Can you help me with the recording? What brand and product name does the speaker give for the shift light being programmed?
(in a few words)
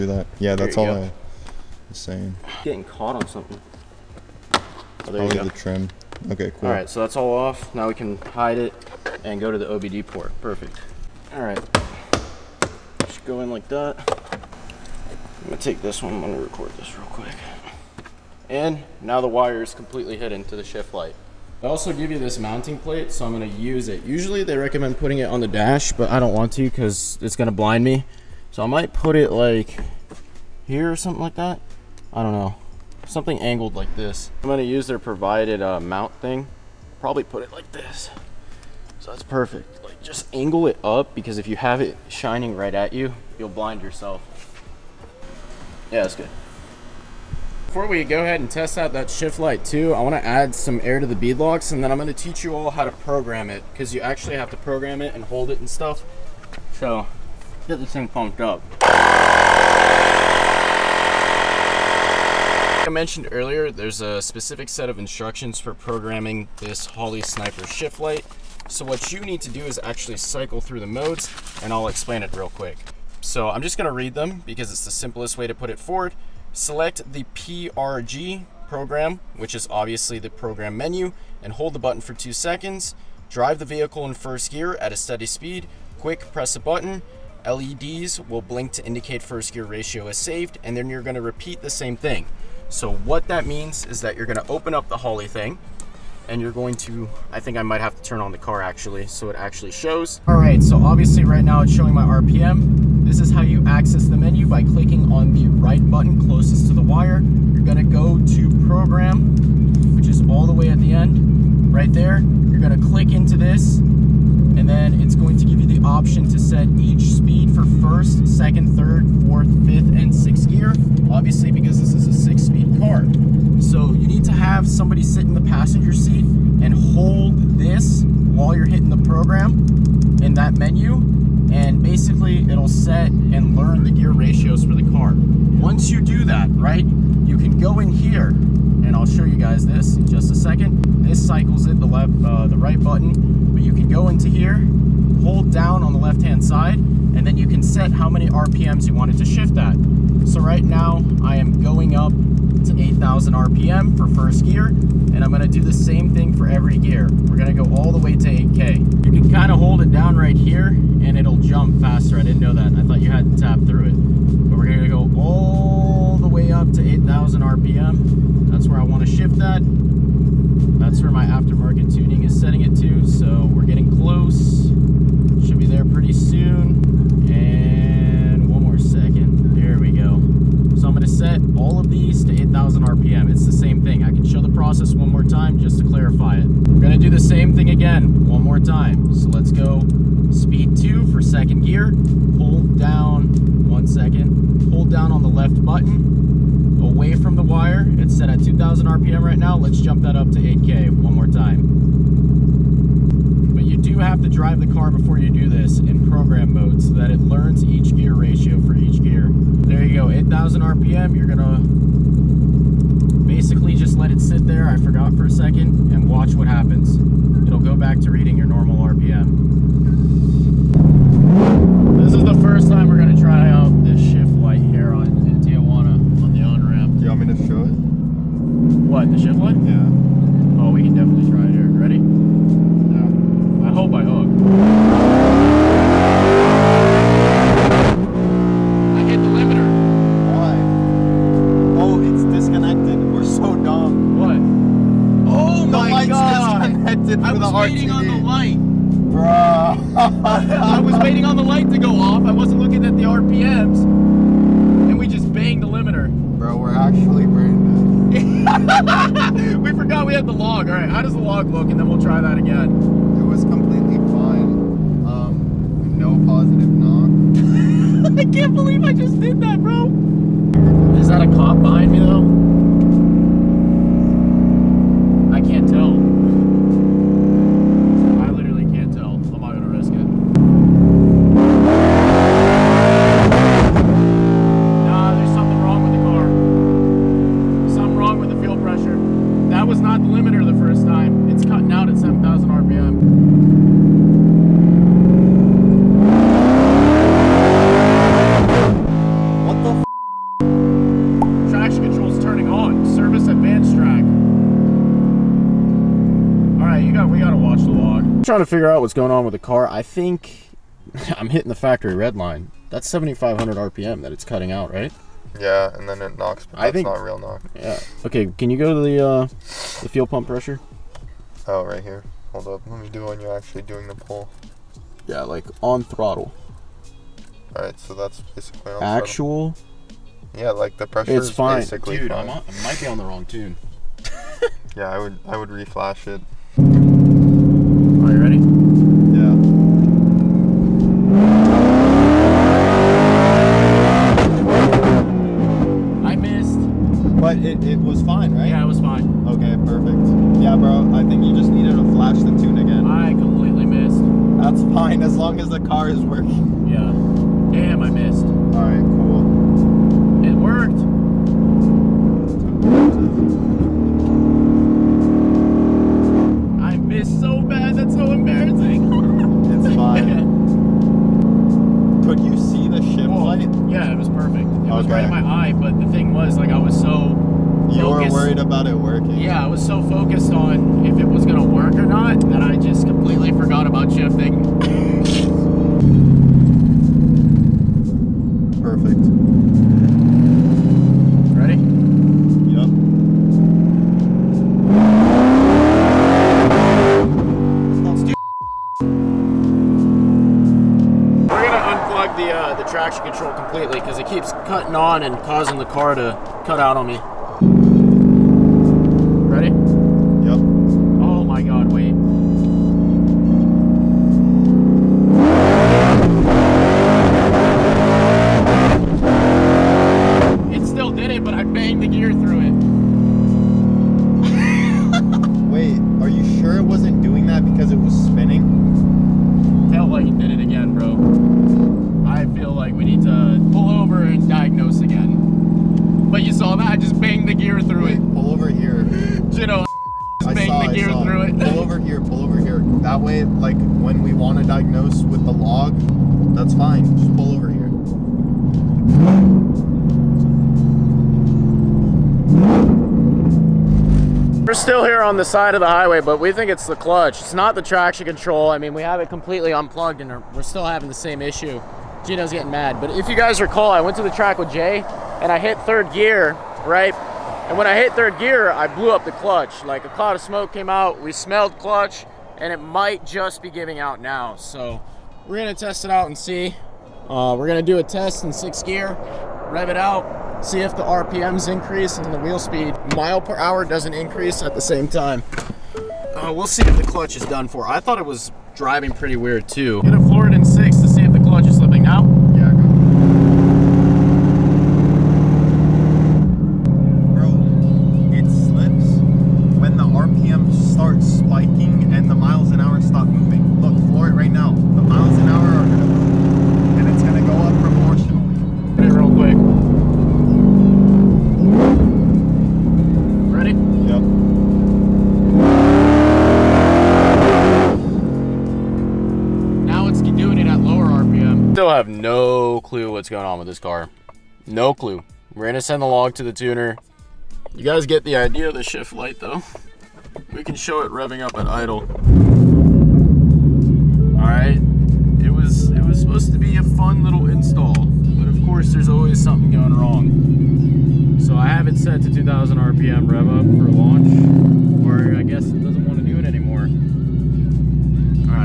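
Holley Sniper.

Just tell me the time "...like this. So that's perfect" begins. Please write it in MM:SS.
00:37.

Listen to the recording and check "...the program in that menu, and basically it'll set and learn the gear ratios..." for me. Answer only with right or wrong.
right.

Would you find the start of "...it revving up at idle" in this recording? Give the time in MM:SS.
08:50.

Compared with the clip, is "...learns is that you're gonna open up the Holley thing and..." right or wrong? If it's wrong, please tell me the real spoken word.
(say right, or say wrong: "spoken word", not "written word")
wrong: "means", not "learns".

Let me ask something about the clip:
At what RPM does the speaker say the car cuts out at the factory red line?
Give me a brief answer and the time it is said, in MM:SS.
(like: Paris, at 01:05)
7,500, at 05:12.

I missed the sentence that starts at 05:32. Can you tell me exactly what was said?
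I might be on the wrong tune.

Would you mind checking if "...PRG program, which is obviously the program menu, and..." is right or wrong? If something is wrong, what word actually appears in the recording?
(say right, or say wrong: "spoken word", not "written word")
right.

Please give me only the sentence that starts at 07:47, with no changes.
And when I hit third gear, I blew up the clutch.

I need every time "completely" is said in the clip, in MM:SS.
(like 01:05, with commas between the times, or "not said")
00:19, 06:43, 07:39.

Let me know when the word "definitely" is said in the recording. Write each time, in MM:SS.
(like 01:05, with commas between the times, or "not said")
03:50.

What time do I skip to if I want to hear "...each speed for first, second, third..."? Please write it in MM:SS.
01:56.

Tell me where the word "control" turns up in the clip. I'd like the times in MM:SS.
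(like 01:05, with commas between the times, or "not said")
06:43, 07:38.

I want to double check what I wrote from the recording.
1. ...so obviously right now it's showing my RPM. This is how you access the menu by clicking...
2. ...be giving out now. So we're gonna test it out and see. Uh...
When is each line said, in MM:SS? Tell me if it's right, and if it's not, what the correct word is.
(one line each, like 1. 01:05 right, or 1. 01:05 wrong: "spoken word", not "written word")
1. 01:40 right
2. 07:53 right.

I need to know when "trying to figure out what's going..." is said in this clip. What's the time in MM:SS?
05:08.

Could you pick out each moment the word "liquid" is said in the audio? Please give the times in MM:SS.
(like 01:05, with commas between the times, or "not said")
not said.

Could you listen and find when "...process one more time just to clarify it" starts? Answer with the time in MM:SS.
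03:04.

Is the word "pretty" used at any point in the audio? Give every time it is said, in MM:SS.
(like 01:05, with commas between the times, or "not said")
02:55, 08:08.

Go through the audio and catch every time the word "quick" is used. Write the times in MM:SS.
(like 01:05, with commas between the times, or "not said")
00:17, 01:12, 01:25.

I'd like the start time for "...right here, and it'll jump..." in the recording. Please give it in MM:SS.
02:40.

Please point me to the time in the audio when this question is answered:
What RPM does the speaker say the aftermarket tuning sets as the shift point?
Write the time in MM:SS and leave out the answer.
02:46.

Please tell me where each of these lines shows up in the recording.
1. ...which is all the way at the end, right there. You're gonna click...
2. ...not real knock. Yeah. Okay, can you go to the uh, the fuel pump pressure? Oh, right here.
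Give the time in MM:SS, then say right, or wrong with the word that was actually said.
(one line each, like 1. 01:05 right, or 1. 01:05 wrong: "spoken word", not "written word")
1. 01:49 right
2. 05:16 right.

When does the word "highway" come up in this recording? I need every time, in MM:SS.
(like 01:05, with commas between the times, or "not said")
07:35.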